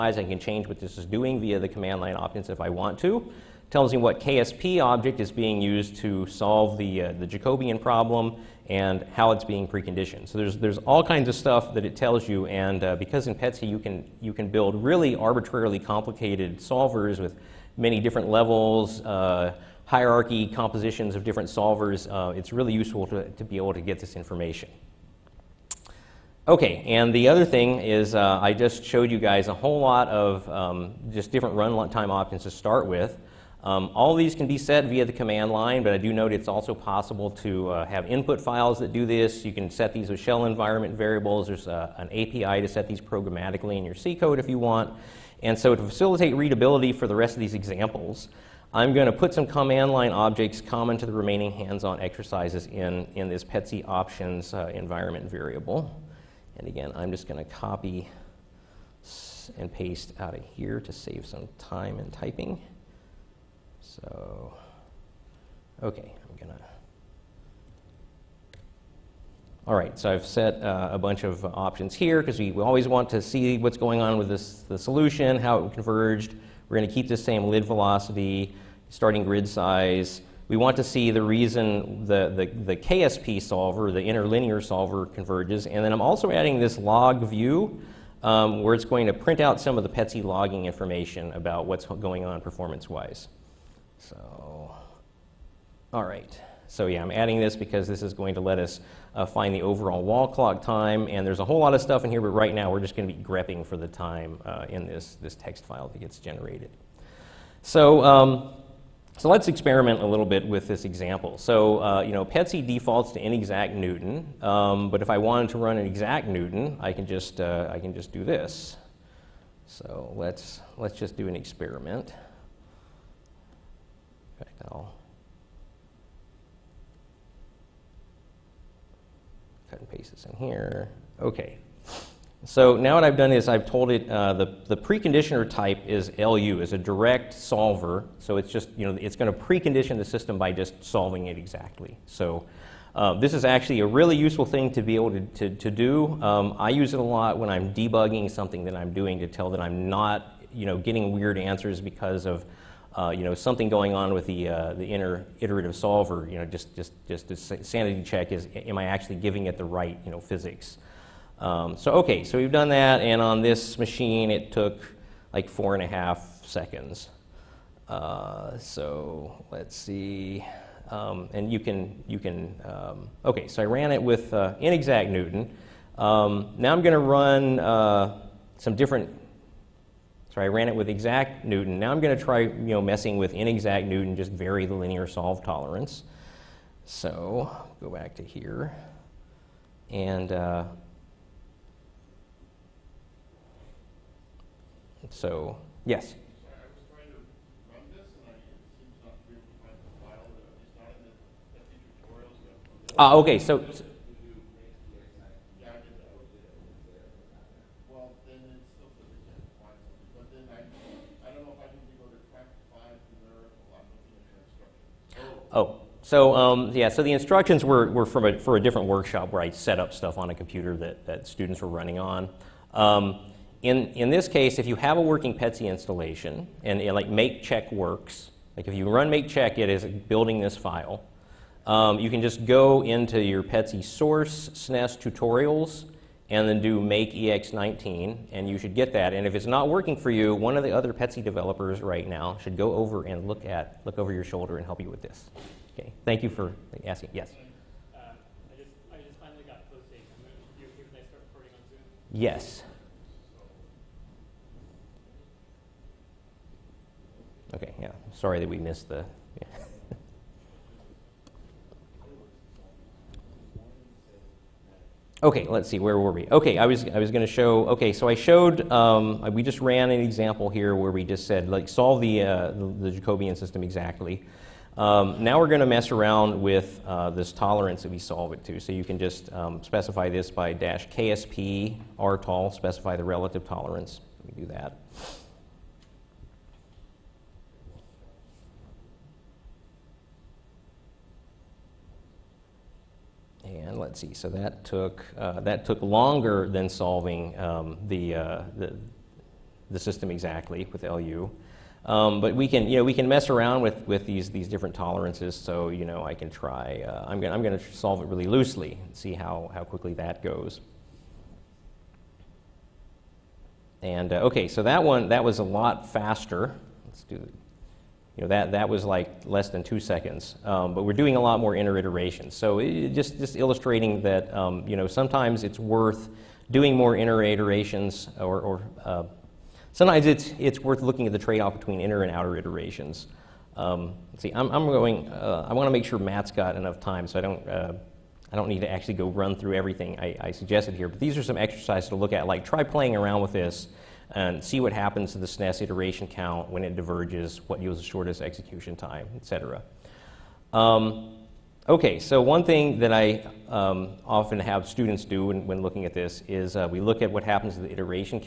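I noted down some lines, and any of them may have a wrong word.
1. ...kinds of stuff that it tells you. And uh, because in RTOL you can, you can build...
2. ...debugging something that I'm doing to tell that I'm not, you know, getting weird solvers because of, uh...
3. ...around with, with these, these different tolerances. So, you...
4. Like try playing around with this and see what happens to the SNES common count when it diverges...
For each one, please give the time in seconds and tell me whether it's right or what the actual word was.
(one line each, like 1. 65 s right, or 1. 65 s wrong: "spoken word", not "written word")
1. 11 s wrong: "PETSc", not "RTOL"
2. 147 s wrong: "answers", not "solvers"
3. 303 s right
4. 342 s wrong: "iteration", not "common".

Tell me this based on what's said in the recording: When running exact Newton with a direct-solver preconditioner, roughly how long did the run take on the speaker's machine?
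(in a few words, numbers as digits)
4.5 seconds.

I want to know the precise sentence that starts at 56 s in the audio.
And again, I'm just going to copy and paste out of here to save some time in typing.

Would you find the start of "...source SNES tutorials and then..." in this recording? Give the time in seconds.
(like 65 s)
233 s.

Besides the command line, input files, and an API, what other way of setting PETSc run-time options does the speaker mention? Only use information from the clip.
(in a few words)
Shell environment variables.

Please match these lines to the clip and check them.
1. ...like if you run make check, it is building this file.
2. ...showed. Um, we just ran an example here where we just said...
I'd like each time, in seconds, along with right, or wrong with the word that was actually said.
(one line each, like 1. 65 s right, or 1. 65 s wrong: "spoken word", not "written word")
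1. 228 s right
2. 268 s right.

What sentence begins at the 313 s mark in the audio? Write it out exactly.
And uh, okay, so that one, that was a lot faster.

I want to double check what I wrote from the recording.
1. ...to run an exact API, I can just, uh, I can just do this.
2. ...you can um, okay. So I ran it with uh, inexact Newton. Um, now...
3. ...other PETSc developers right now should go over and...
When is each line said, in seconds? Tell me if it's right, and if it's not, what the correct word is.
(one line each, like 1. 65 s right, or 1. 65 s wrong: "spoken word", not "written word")
1. 115 s wrong: "Newton", not "API"
2. 172 s right
3. 240 s right.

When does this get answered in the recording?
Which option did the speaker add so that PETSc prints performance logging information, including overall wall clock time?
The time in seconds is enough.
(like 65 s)
86 s.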